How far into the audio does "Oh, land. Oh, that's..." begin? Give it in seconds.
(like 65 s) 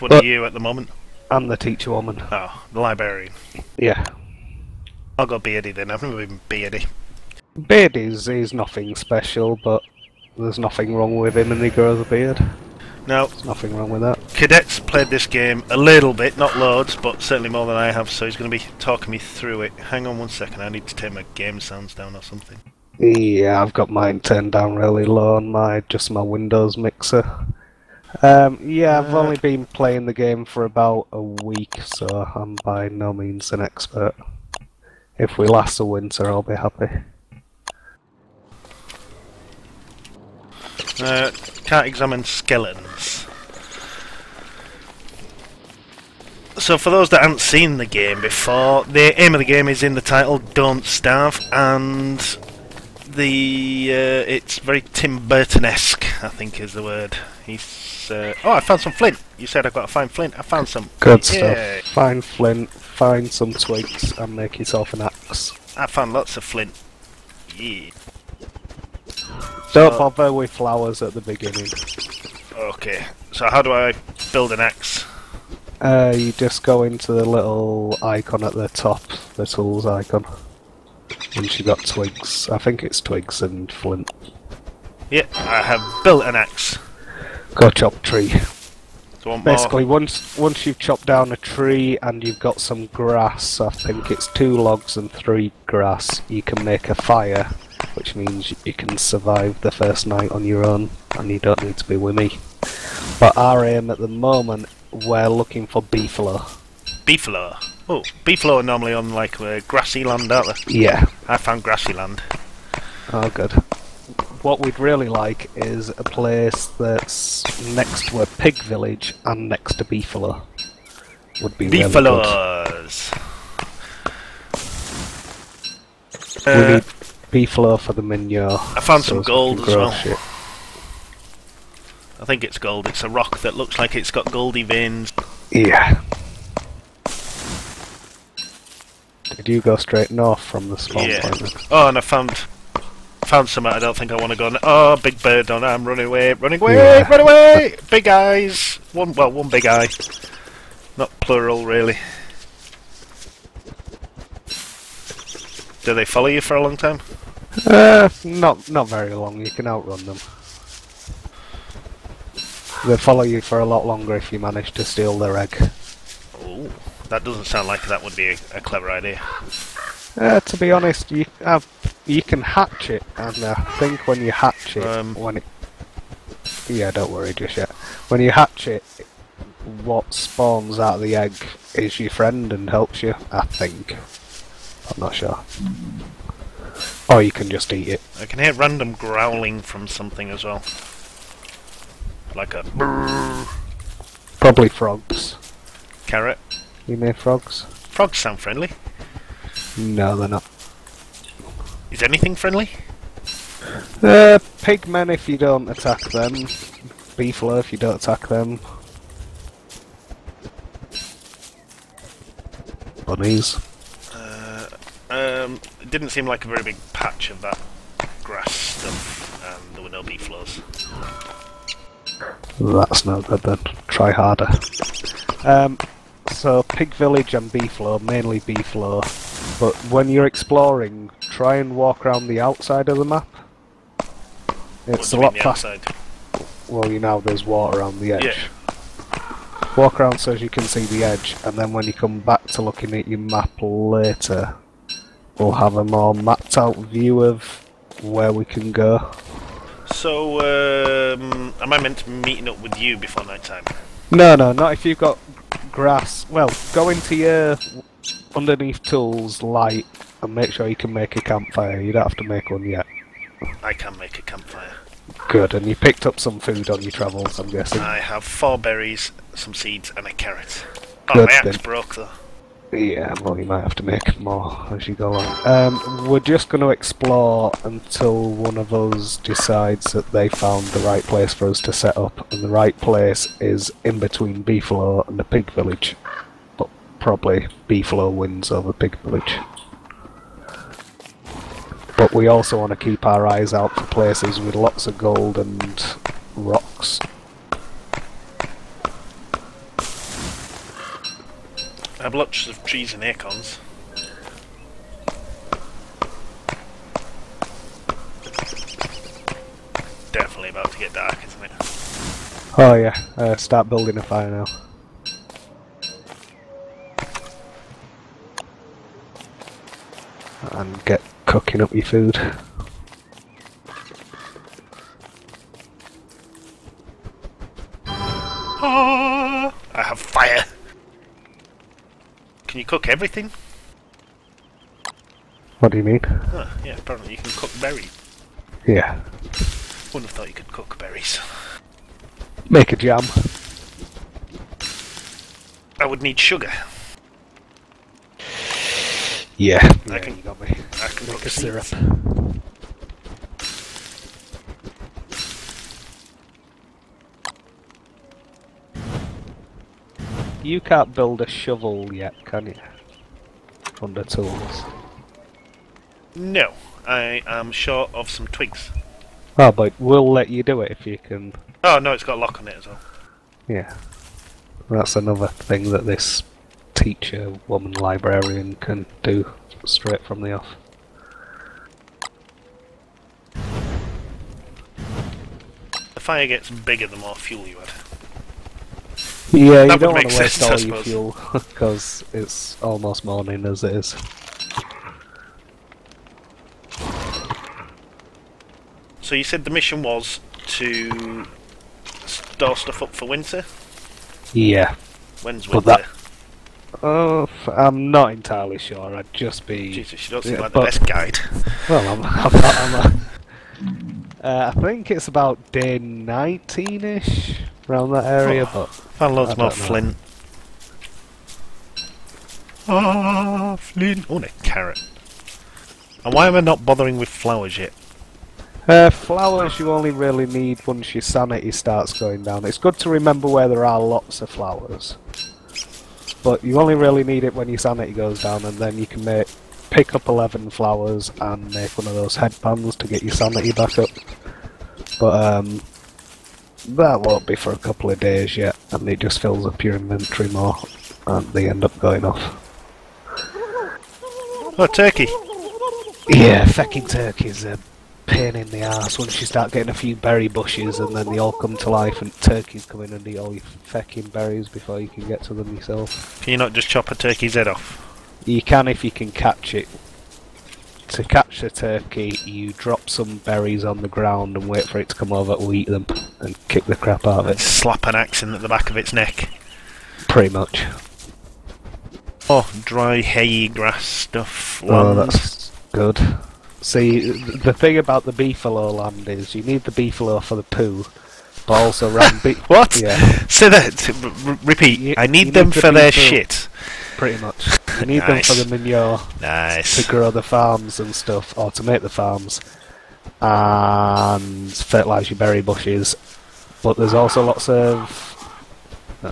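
484 s.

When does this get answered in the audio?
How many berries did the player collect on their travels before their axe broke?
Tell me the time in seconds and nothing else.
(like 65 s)
268 s.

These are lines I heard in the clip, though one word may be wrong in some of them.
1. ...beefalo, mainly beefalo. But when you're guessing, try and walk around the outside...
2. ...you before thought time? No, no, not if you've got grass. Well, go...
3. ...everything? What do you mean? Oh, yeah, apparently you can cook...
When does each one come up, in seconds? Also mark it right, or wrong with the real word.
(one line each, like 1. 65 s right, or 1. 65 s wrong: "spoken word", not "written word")
1. 227 s wrong: "exploring", not "guessing"
2. 252 s wrong: "night", not "thought"
3. 332 s right.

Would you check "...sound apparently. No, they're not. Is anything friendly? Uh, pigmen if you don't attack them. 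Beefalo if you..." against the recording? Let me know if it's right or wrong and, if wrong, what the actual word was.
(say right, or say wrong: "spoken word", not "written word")
wrong: "friendly", not "apparently".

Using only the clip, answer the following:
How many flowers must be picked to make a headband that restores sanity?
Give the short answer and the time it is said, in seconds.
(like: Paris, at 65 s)
11, at 440 s.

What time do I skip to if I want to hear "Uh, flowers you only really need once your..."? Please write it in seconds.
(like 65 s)
428 s.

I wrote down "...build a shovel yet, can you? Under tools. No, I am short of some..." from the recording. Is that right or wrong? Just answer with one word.
right.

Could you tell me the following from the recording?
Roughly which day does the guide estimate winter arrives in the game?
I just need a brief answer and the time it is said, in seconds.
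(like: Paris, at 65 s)
Day 19, at 415 s.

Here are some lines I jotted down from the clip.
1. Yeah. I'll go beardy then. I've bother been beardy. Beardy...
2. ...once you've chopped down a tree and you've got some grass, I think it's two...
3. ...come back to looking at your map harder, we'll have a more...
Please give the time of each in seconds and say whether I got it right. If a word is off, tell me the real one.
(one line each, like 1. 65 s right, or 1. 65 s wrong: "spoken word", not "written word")
1. 3 s wrong: "never", not "bother"
2. 90 s right
3. 241 s wrong: "later", not "harder".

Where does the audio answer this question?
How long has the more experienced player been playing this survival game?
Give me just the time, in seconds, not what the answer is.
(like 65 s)
30 s.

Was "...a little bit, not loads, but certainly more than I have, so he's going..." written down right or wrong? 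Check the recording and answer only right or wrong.
right.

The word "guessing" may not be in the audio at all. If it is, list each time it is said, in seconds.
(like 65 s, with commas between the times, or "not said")
267 s.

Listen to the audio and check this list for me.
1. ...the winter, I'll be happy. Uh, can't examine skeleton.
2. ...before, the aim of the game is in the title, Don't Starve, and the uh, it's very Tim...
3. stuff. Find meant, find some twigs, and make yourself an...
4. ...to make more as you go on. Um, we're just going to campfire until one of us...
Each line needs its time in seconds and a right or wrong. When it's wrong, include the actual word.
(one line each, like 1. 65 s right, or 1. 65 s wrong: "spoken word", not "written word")
1. 35 s right
2. 48 s right
3. 61 s wrong: "flint", not "meant"
4. 273 s wrong: "explore", not "campfire".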